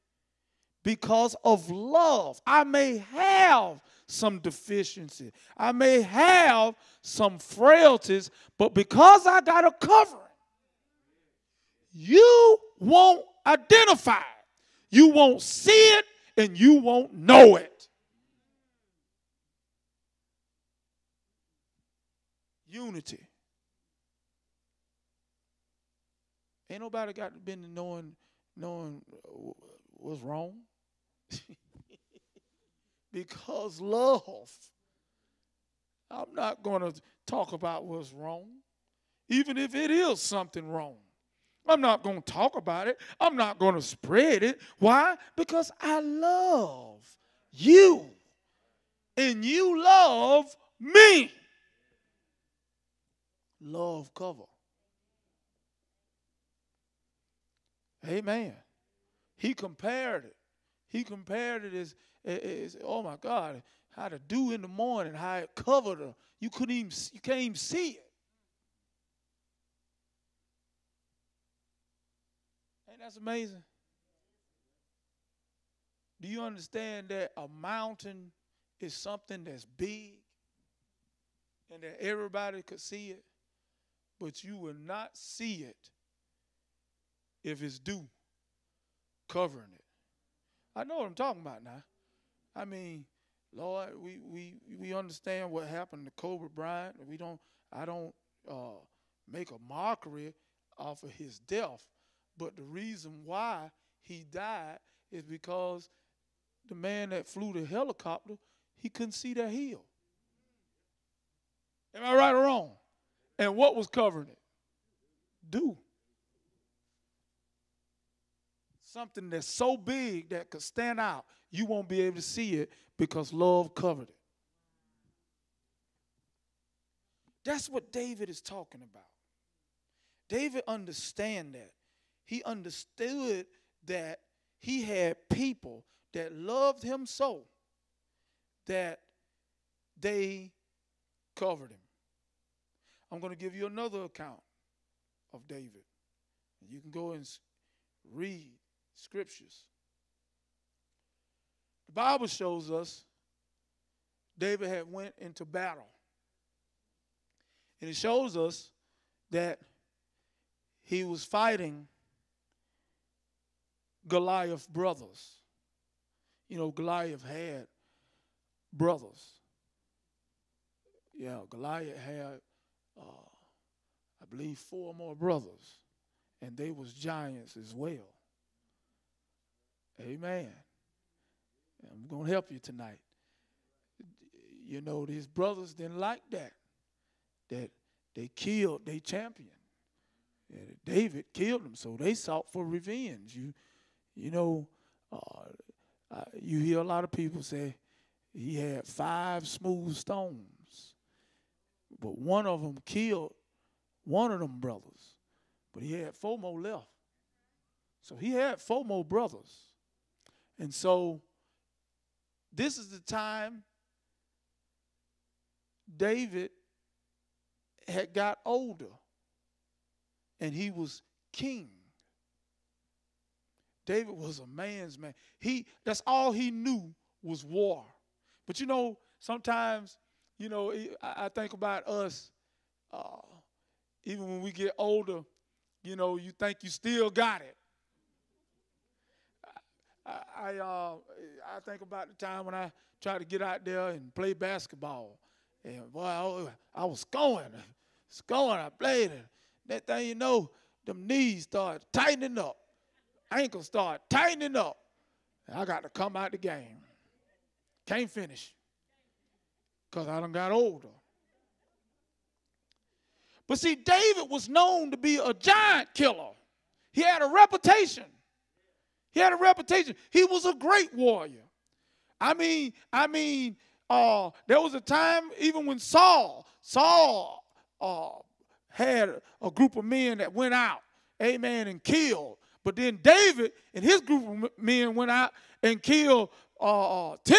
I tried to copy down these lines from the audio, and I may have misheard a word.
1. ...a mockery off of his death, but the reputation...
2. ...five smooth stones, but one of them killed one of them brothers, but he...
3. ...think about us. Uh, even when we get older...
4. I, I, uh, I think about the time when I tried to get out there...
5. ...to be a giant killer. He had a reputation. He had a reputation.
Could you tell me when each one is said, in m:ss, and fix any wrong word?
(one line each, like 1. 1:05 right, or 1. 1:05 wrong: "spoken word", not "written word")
1. 1:39 wrong: "reason", not "reputation"
2. 3:18 right
3. 3:51 right
4. 4:00 right
5. 4:24 right.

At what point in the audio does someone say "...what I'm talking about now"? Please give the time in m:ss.
1:30.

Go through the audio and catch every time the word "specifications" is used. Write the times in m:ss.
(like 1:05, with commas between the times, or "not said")
not said.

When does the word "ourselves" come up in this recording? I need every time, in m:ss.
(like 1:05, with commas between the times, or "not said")
not said.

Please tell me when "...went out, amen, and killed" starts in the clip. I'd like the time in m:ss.
4:40.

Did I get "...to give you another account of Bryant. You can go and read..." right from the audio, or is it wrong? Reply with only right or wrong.
wrong.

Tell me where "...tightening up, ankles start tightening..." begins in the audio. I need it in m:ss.
4:11.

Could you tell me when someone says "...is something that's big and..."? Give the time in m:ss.
1:18.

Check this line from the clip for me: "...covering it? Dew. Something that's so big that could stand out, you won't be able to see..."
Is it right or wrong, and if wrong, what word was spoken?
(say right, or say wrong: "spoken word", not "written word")
right.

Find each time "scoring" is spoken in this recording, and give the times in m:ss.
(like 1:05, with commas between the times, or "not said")
4:08.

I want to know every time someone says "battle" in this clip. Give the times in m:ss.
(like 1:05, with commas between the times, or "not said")
2:35.